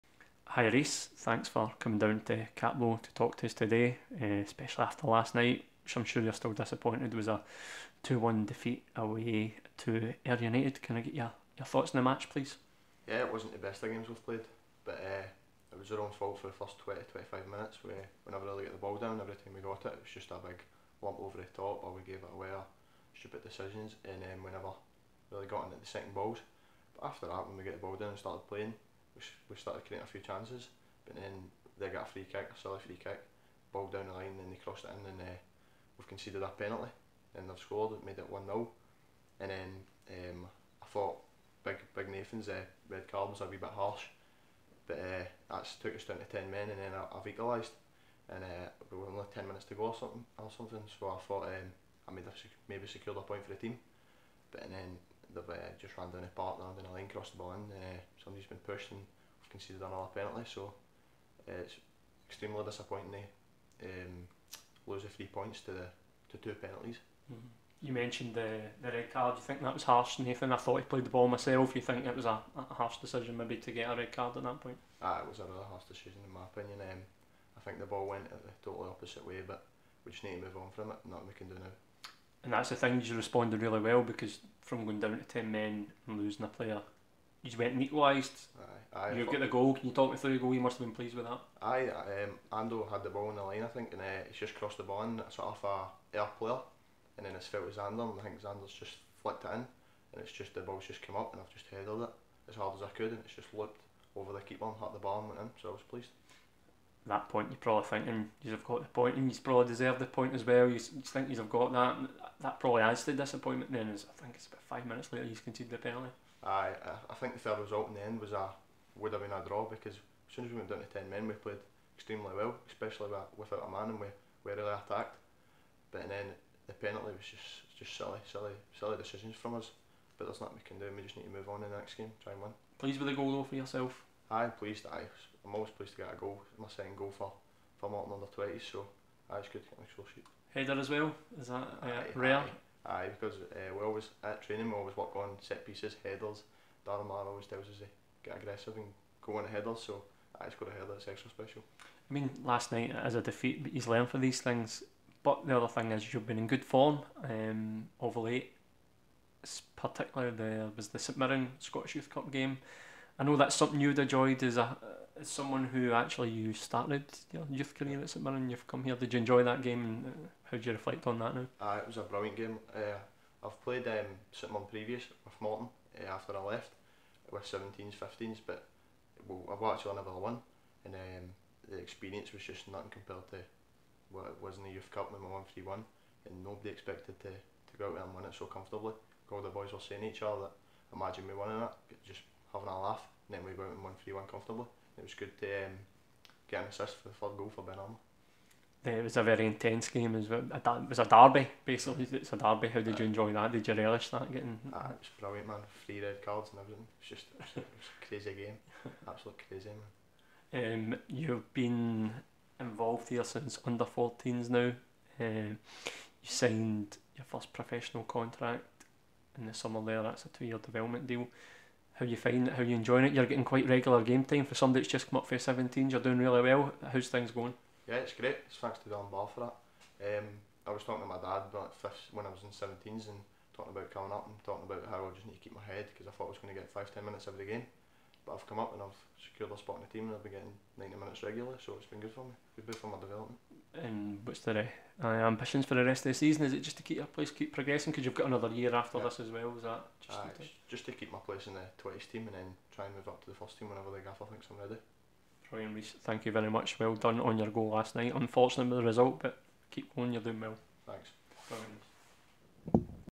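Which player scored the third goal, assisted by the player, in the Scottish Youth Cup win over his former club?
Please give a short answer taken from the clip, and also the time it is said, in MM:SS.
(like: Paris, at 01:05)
Ben Armour, at 03:17.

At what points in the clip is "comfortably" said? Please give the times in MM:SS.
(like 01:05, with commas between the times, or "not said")
03:08, 03:14.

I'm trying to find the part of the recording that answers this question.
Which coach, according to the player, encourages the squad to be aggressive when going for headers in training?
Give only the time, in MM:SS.
02:26.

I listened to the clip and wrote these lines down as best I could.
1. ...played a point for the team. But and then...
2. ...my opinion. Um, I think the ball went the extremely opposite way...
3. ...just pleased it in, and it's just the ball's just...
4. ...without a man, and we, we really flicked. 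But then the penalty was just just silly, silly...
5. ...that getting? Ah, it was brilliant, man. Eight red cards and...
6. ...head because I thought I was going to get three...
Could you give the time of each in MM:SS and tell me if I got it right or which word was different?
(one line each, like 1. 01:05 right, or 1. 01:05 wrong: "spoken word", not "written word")
1. 00:52 wrong: "secured", not "played"
2. 01:16 wrong: "totally", not "extremely"
3. 01:38 wrong: "flicked", not "pleased"
4. 02:03 wrong: "attacked", not "flicked"
5. 03:24 wrong: "Three", not "Eight"
6. 03:55 wrong: "five", not "three".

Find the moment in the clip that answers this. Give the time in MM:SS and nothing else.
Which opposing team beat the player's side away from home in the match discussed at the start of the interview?
00:10.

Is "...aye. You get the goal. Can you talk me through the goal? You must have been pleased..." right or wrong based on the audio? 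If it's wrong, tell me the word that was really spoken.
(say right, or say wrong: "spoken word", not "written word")
right.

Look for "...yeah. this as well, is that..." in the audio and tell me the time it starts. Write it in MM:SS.
04:08.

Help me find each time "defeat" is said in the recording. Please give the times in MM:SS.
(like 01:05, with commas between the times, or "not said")
00:08, 02:33.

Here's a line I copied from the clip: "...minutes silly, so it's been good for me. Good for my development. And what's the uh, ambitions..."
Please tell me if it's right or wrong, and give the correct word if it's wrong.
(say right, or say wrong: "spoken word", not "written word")
wrong: "regularly", not "silly".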